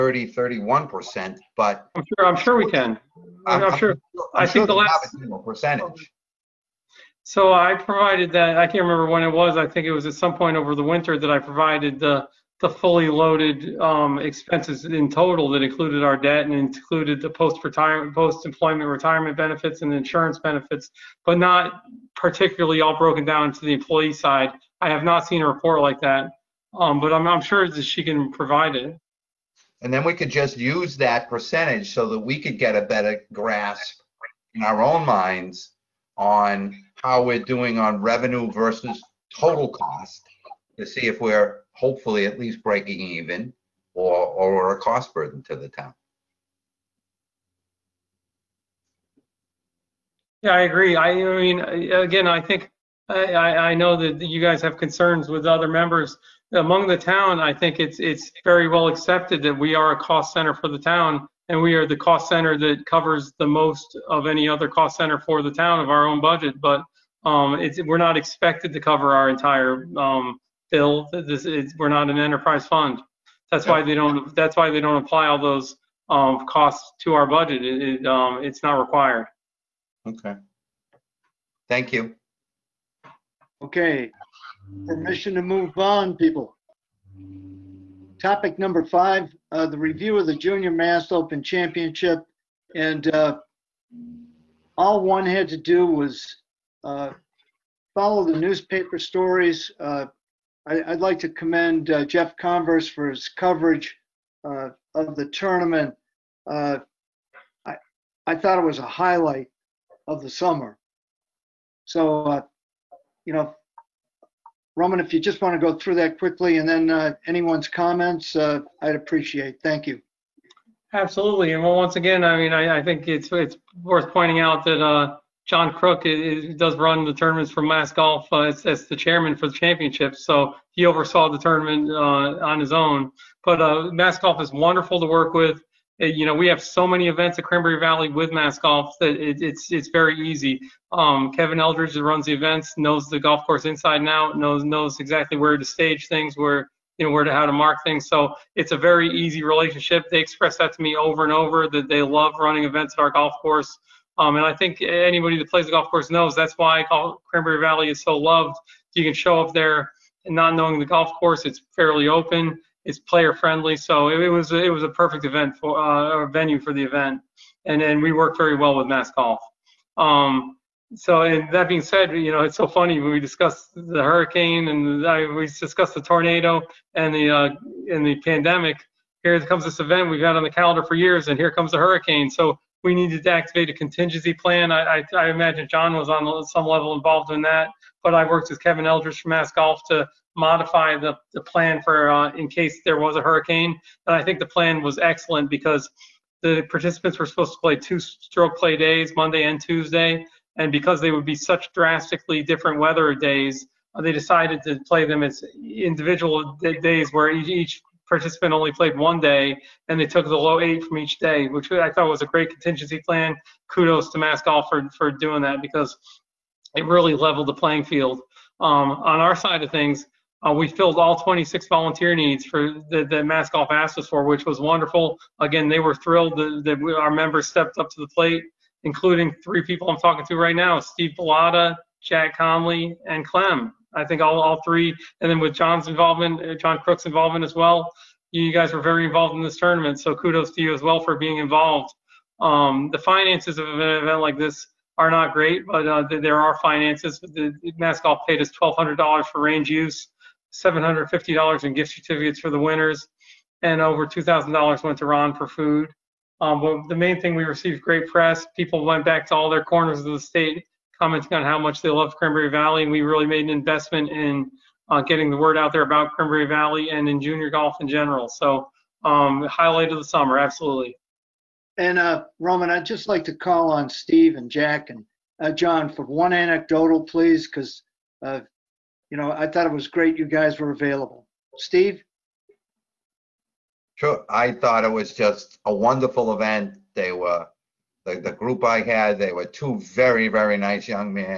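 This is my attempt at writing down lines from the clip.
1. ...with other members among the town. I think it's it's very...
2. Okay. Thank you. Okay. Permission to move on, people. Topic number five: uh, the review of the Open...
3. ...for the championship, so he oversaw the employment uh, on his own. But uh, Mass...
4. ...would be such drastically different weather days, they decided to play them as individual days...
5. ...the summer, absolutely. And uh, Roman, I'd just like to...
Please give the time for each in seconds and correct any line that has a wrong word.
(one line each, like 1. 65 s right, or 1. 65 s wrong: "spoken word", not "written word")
1. 55 s right
2. 80 s wrong: "Junior", not "Open"
3. 129 s wrong: "tournament", not "employment"
4. 201 s right
5. 269 s right.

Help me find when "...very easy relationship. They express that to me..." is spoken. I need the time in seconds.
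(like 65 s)
148 s.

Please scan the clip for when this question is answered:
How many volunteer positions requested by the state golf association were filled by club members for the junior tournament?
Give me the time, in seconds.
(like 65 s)
221 s.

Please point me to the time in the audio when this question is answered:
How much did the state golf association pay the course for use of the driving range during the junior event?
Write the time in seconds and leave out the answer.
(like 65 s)
248 s.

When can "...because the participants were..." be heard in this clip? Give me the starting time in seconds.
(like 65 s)
195 s.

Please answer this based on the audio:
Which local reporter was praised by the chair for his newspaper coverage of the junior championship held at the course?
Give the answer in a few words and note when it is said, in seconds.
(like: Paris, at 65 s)
Jeff Converse, at 102 s.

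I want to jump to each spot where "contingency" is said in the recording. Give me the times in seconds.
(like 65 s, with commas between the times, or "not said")
183 s, 212 s.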